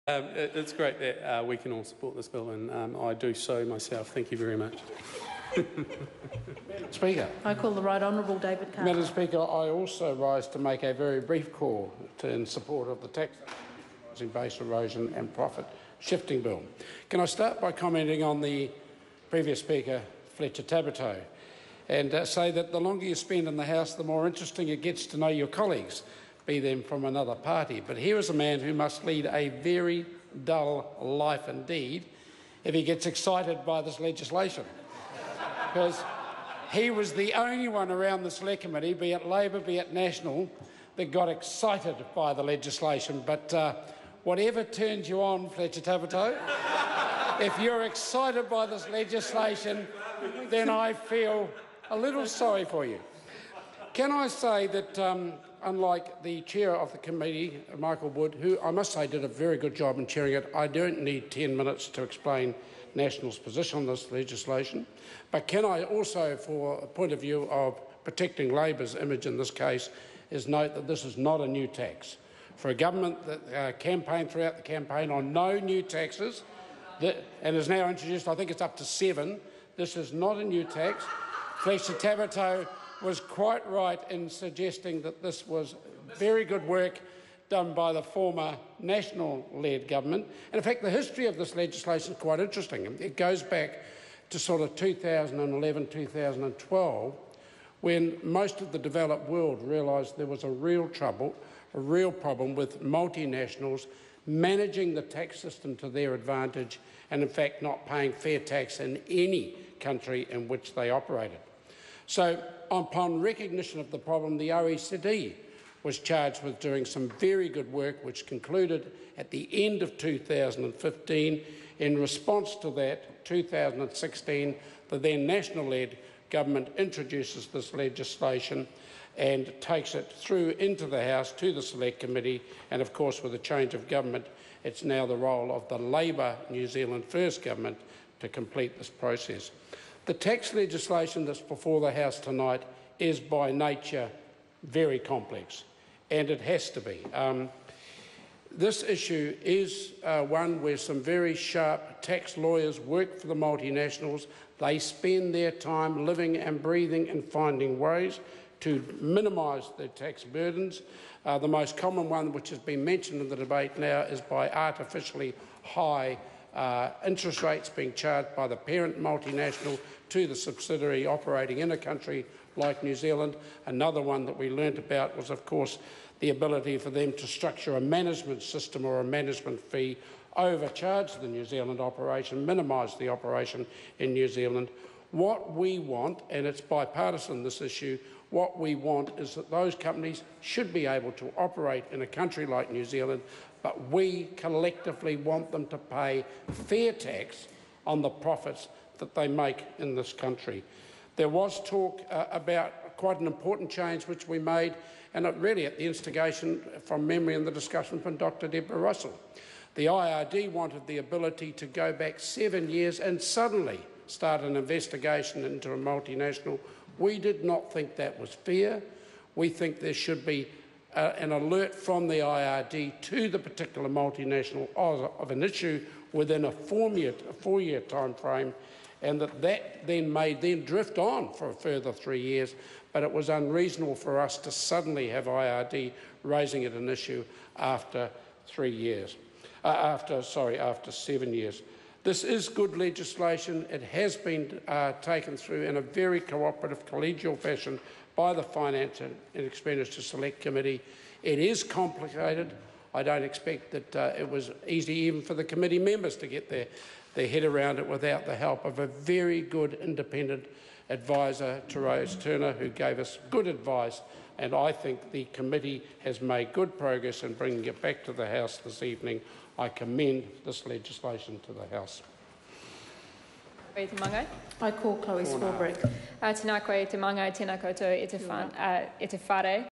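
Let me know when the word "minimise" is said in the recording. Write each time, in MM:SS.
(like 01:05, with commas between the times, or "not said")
02:38, 03:02.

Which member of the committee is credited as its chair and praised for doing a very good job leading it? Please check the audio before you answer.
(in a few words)
Michael Wood.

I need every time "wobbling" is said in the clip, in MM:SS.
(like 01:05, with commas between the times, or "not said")
not said.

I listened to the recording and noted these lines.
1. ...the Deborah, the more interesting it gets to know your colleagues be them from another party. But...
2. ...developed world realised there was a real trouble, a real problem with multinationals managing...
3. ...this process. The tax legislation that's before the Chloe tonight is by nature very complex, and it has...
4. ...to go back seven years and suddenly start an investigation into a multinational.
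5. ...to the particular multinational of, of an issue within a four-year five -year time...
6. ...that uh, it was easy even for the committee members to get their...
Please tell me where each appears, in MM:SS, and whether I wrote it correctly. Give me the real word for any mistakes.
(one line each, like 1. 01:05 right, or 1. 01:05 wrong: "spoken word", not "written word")
1. 00:23 wrong: "House", not "Deborah"
2. 01:38 right
3. 02:18 wrong: "House", not "Chloe"
4. 03:31 right
5. 03:43 wrong: "four", not "five"
6. 04:13 right.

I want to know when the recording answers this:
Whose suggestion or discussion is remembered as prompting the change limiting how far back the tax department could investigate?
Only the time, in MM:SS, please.
03:28.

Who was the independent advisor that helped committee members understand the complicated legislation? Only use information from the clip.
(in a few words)
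Therese Turner.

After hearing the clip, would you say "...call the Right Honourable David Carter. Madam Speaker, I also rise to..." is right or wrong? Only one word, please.
right.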